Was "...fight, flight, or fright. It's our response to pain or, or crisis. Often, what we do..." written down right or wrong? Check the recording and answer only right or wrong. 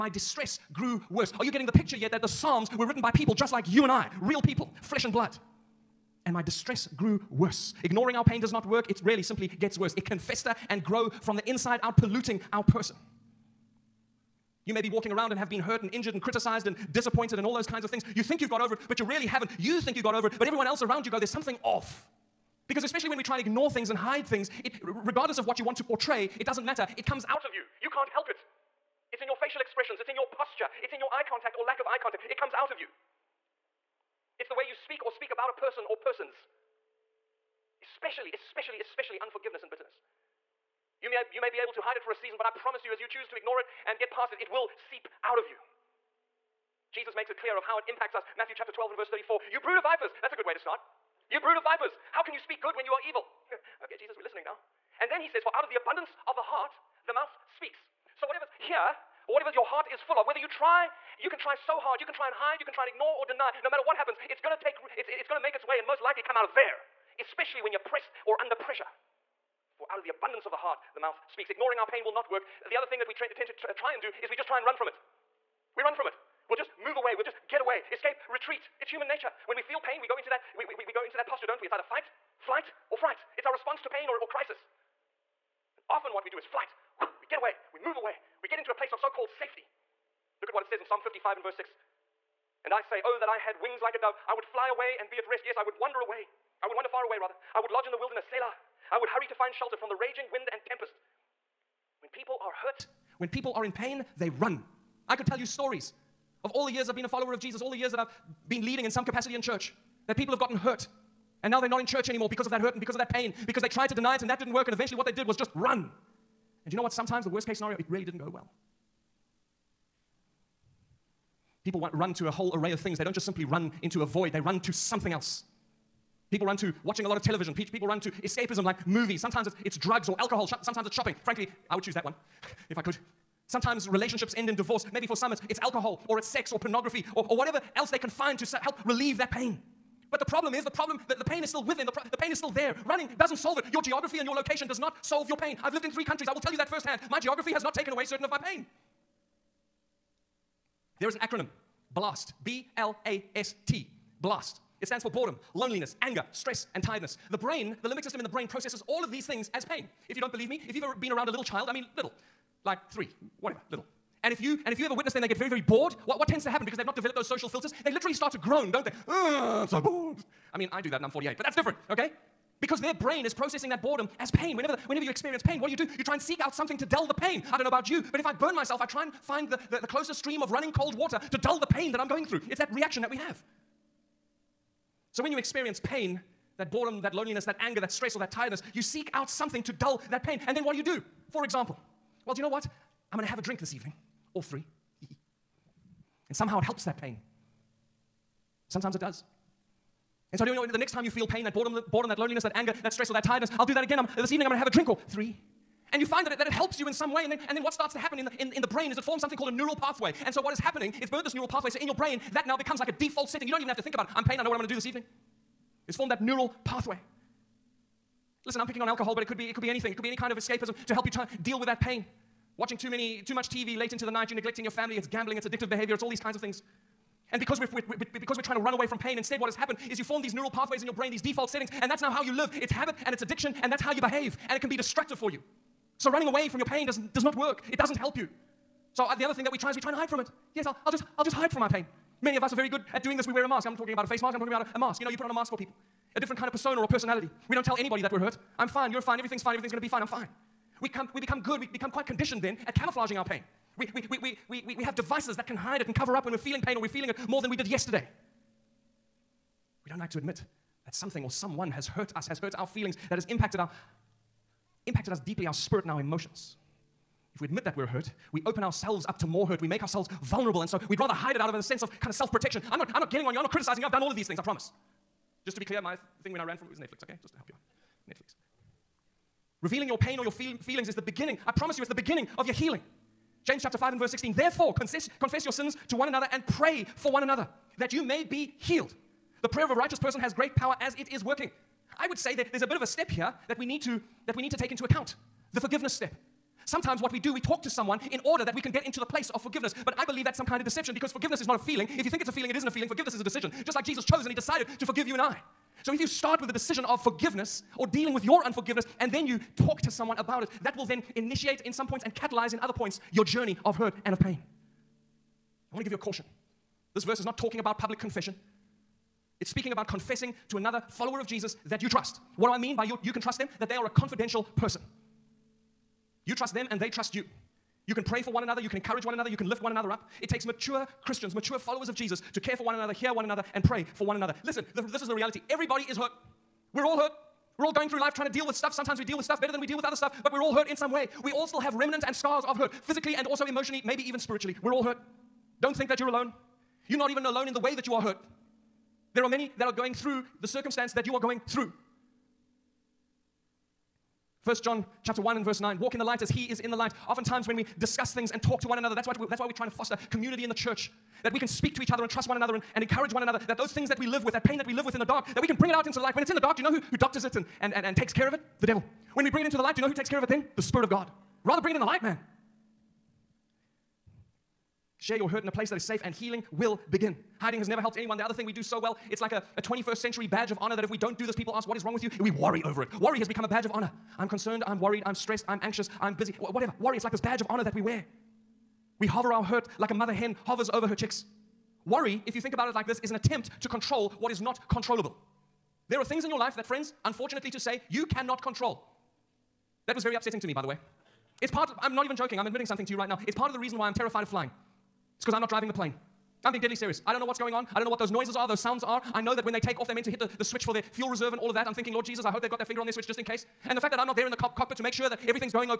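right.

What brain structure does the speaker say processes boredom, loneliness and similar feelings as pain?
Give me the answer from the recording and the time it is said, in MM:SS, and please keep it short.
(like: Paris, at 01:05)
limbic system, at 02:37.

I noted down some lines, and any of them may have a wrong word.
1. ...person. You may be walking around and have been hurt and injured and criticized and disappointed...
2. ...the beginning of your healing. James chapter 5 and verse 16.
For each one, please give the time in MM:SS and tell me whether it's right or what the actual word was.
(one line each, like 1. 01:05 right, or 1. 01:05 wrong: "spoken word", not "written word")
1. 00:12 right
2. 04:41 right.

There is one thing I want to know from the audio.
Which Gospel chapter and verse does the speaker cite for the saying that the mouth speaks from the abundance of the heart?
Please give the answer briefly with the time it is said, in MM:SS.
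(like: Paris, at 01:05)
Matthew 12:34, at 00:48.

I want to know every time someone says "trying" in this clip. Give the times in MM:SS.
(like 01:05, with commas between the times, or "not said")
03:48, 05:38, 05:59.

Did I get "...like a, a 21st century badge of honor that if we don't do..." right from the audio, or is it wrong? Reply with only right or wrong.
right.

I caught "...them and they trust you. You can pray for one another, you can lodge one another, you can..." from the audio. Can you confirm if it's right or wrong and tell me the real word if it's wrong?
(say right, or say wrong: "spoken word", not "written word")
wrong: "encourage", not "lodge".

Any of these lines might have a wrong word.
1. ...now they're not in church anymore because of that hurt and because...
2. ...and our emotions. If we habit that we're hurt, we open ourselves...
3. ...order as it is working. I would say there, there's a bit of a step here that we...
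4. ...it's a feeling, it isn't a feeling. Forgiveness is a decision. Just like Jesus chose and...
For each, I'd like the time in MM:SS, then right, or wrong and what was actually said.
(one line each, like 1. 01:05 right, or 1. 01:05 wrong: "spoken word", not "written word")
1. 01:51 right
2. 04:25 wrong: "admit", not "habit"
3. 04:50 wrong: "power", not "order"
4. 05:02 right.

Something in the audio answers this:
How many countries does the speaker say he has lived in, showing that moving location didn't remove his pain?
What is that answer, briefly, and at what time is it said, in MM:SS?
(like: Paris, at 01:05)
3, at 02:25.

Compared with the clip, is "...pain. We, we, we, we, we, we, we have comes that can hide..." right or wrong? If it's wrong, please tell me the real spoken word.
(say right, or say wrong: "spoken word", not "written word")
wrong: "devices", not "comes".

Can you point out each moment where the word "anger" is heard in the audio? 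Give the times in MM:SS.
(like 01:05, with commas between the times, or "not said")
02:36, 03:07, 03:22.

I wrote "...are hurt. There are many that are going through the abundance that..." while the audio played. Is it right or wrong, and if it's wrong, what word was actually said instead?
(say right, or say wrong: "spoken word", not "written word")
wrong: "circumstance", not "abundance".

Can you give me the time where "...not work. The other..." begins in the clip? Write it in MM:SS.
01:12.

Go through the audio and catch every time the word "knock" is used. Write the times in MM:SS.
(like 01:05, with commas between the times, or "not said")
not said.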